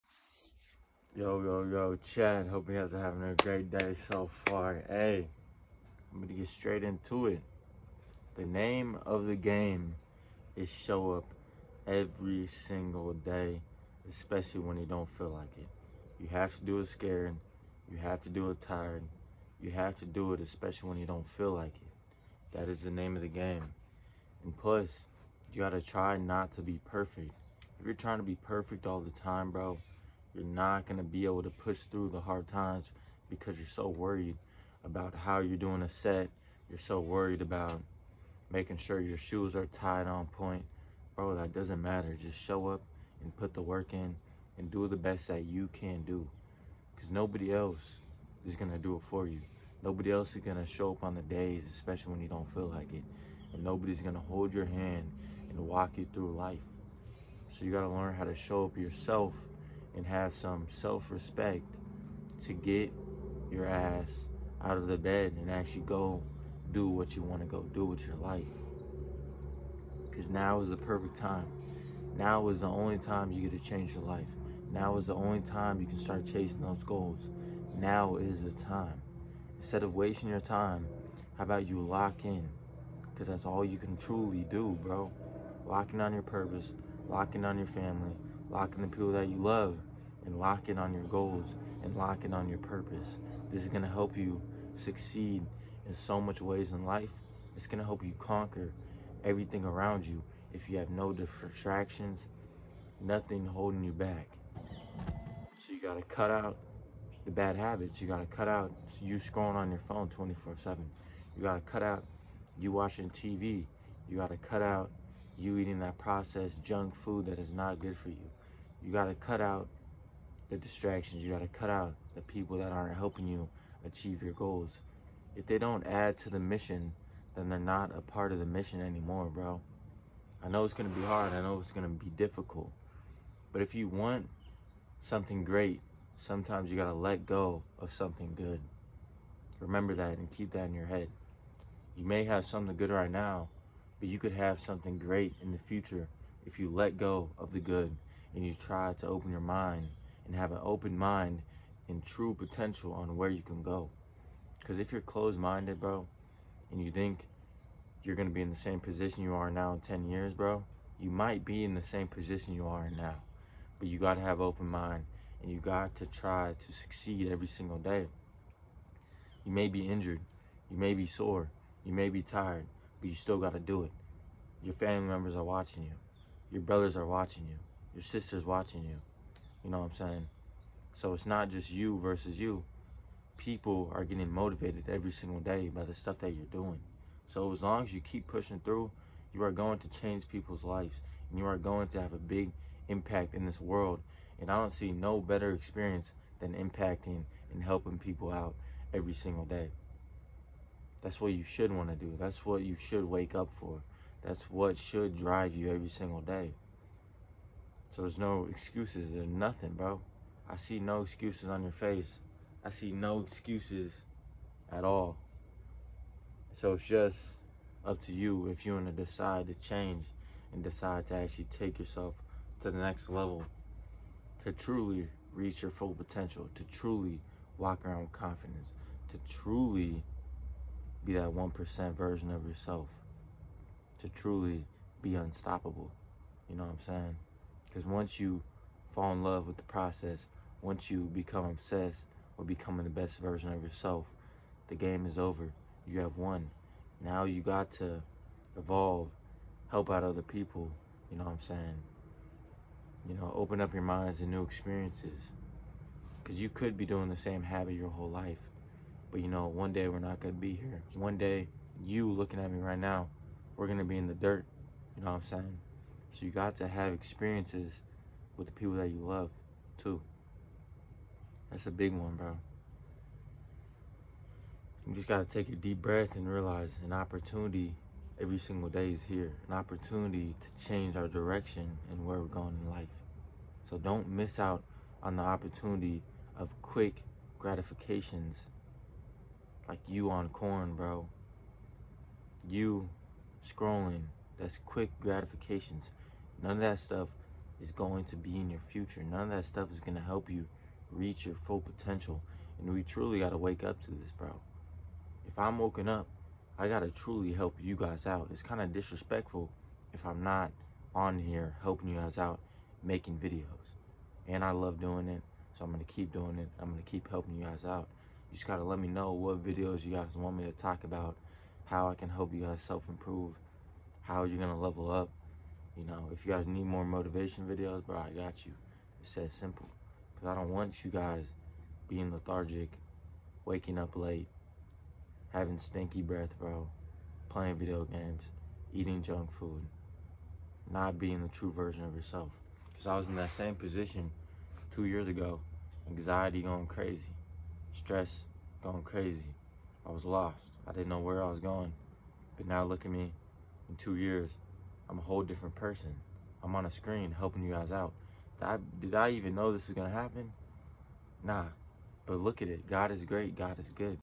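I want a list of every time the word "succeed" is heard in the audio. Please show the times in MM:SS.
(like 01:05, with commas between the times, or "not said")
01:34, 02:46.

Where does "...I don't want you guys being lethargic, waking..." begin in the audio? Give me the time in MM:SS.
05:30.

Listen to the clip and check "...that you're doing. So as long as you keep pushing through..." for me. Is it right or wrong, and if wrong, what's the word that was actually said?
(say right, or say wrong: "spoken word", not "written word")
right.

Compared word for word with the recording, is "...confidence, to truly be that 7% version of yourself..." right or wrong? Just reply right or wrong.
wrong.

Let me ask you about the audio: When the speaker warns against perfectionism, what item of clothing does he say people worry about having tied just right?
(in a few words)
Shoes.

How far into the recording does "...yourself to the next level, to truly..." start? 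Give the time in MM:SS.
03:41.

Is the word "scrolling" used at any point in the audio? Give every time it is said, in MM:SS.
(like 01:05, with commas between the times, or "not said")
01:49, 04:53.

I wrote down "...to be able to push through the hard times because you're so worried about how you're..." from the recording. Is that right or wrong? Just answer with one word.
right.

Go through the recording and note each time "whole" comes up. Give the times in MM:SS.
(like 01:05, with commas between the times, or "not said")
04:17, 05:55.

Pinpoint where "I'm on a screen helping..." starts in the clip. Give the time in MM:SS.
05:56.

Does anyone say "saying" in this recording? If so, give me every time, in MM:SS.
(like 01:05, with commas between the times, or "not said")
02:59, 03:56, 04:11, 04:25.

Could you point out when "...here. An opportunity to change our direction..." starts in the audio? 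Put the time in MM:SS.
04:39.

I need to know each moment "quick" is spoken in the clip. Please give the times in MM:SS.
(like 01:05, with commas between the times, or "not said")
04:46, 04:54.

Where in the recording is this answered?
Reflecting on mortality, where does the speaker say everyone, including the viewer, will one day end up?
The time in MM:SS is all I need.
04:23.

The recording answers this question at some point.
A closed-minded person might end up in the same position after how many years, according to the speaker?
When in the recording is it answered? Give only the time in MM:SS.
02:39.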